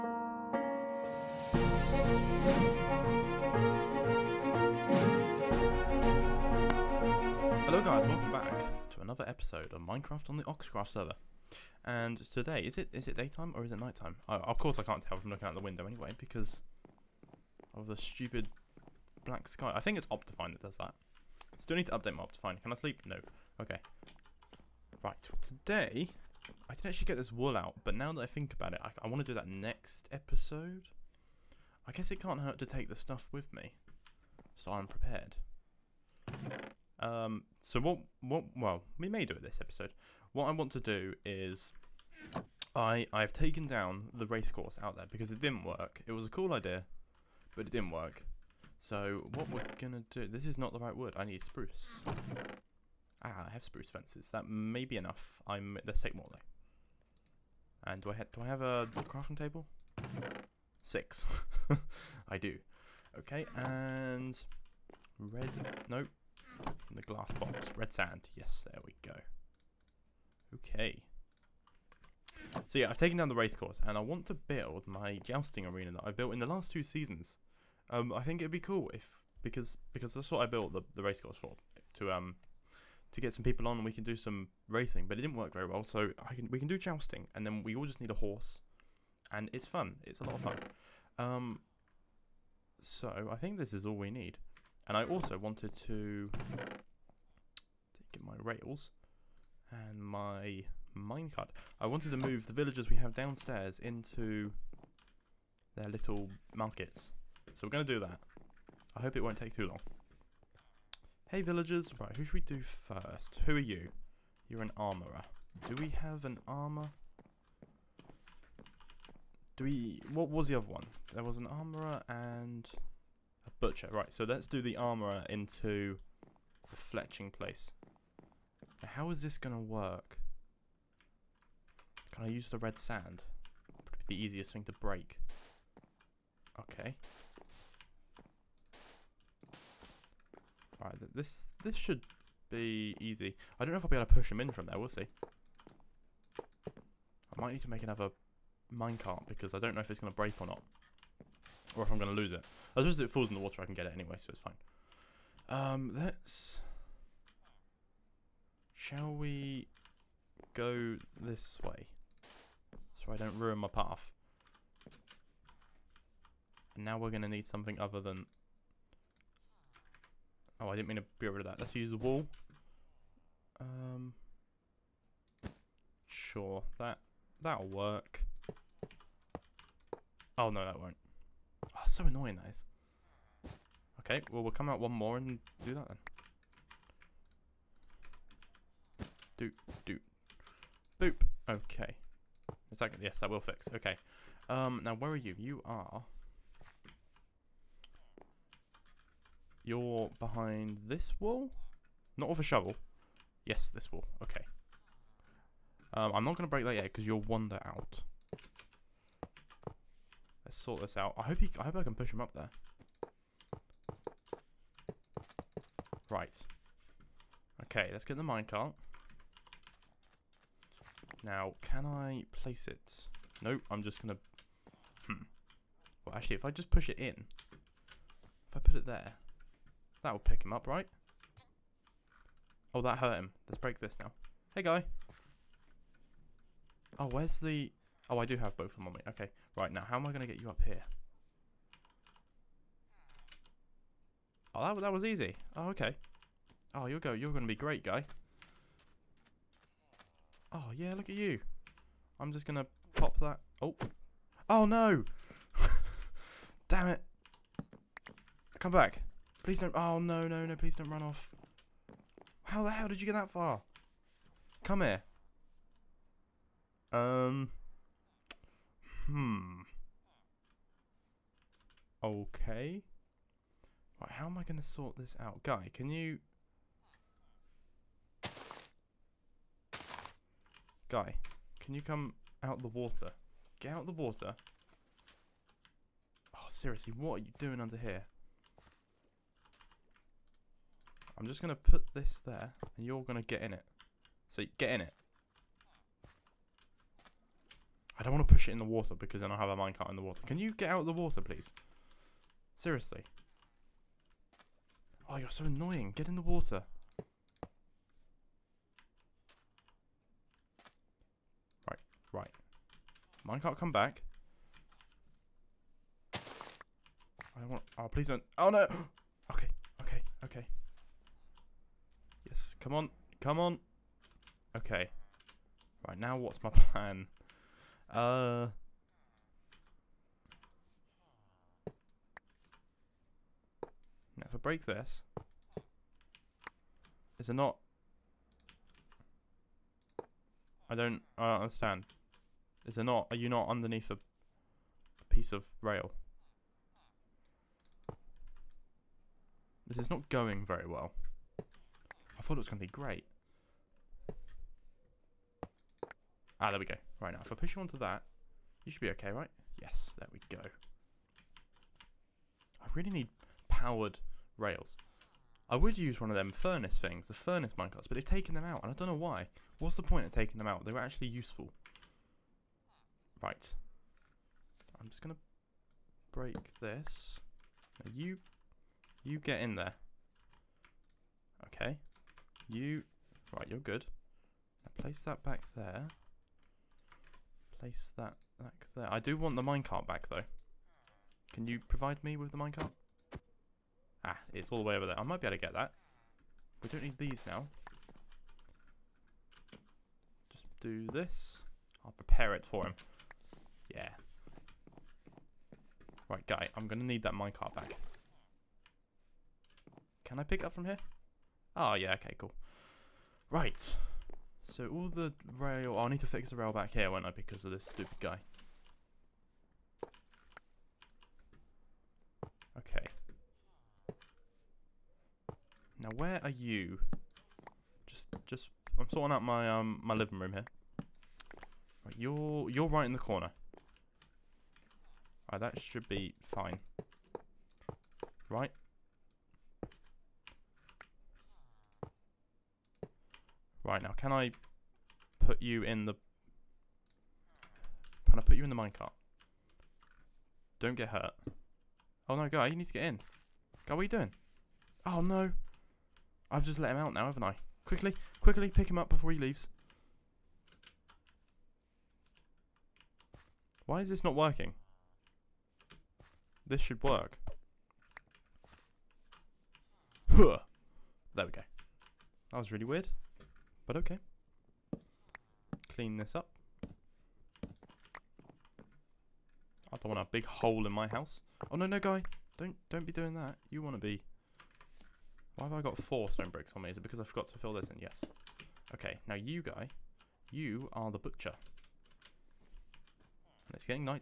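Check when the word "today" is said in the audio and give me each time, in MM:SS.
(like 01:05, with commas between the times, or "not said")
00:12, 00:25.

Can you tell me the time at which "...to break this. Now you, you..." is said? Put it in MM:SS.
06:15.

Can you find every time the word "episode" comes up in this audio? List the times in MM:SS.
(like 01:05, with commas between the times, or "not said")
00:09, 00:30, 00:39.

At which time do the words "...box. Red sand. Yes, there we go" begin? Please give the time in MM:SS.
01:07.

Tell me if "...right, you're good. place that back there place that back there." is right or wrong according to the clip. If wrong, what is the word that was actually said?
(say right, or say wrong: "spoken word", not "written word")
right.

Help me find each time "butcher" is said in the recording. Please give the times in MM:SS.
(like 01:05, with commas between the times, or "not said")
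02:03, 08:10.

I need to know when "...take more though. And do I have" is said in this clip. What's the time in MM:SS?
00:56.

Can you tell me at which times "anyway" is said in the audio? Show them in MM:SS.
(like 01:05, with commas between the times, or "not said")
00:15, 02:33.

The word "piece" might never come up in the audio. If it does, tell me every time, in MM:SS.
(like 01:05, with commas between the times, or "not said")
05:45.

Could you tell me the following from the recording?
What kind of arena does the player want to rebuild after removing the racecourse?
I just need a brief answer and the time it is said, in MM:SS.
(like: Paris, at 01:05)
Jousting arena, at 01:15.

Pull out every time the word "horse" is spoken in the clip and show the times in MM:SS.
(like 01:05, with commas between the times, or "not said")
01:28.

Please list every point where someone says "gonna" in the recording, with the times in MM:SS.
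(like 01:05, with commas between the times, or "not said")
00:49, 03:44.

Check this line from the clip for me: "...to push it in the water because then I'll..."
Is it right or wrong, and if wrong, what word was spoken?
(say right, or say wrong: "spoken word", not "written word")
right.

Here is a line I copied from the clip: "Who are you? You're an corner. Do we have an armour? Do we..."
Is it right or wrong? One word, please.
wrong.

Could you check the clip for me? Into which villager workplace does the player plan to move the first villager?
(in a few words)
The fletching place.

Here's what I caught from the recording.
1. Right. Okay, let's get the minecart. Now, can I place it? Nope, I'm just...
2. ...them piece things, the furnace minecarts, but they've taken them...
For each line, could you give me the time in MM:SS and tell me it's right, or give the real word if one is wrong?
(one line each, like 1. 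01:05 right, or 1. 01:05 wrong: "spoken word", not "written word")
1. 03:36 right
2. 06:06 wrong: "furnace", not "piece".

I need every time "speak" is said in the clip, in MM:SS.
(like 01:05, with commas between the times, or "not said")
not said.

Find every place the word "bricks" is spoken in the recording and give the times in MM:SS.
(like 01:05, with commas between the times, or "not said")
08:06.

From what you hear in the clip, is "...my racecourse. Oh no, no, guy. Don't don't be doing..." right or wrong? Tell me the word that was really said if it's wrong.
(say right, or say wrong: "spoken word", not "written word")
wrong: "house", not "racecourse".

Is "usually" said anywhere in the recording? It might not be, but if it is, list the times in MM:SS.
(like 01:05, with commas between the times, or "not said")
not said.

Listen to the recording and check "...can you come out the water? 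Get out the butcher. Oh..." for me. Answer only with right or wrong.
wrong.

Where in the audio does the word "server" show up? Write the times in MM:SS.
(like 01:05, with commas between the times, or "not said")
00:10.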